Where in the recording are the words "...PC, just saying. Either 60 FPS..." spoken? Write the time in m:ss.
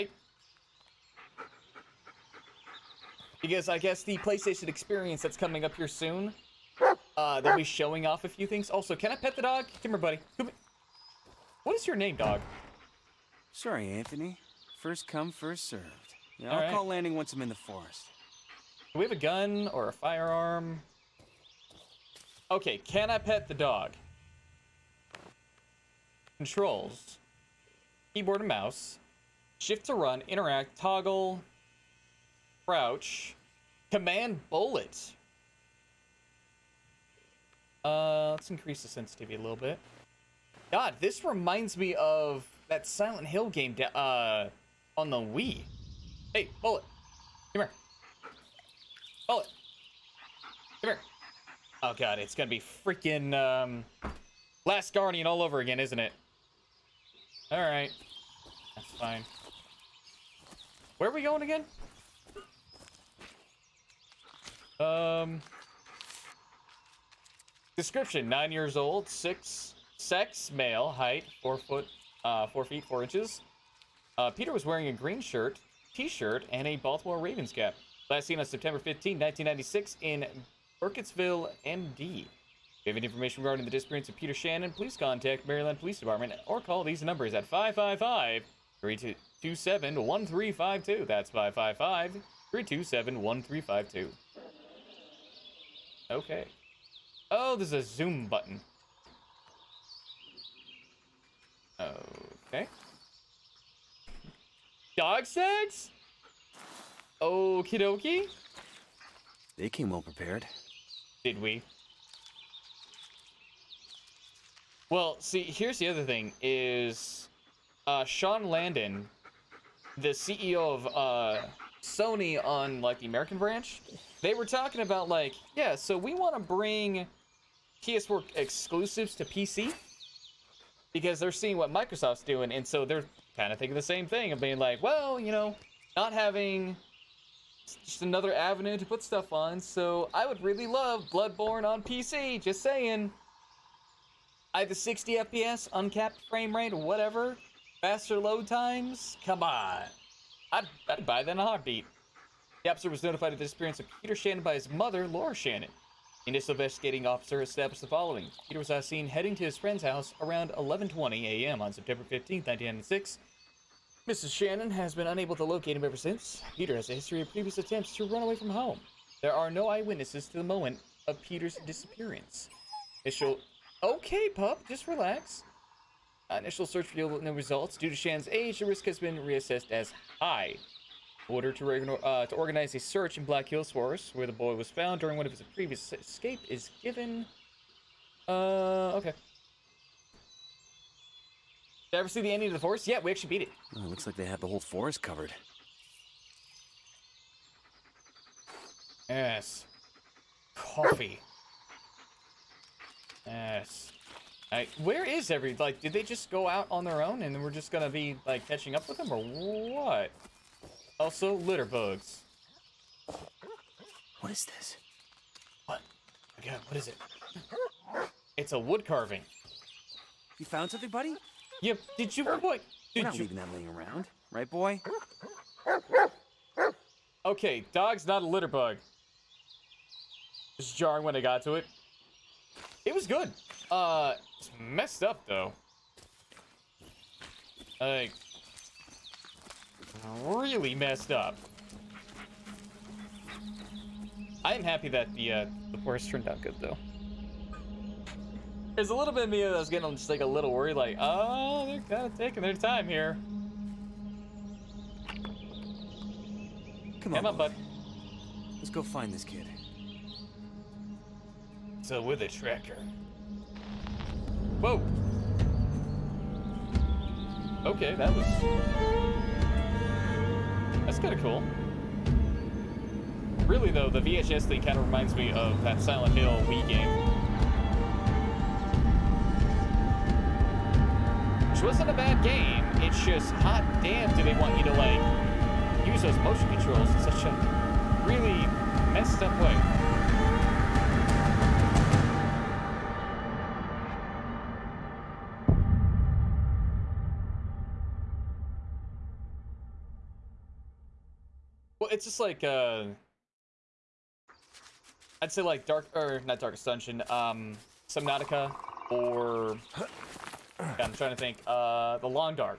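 2:21.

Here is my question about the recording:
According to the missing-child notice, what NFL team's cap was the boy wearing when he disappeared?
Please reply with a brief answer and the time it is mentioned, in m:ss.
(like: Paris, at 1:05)
Baltimore Ravens, at 1:16.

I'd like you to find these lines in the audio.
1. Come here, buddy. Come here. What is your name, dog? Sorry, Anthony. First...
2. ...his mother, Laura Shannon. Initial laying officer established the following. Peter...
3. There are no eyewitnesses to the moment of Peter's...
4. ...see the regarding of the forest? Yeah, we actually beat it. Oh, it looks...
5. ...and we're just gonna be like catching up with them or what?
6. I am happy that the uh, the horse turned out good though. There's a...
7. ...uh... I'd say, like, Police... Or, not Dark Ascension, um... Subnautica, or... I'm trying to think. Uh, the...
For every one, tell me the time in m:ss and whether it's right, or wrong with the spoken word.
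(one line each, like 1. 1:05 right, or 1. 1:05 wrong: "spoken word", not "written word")
1. 0:09 right
2. 2:34 wrong: "investigating", not "laying"
3. 2:49 right
4. 3:12 wrong: "ending", not "regarding"
5. 3:27 right
6. 4:04 right
7. 5:02 wrong: "Dark", not "Police".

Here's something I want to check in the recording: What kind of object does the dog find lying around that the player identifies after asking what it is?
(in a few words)
A wood carving.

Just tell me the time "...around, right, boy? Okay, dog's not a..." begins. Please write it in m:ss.
3:43.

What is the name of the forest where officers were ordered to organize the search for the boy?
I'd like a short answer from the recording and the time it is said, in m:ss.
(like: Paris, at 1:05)
Black Hills Forest, at 3:03.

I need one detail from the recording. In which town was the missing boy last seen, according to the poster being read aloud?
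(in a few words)
Burkittsville.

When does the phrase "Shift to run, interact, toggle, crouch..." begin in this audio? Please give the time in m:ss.
0:29.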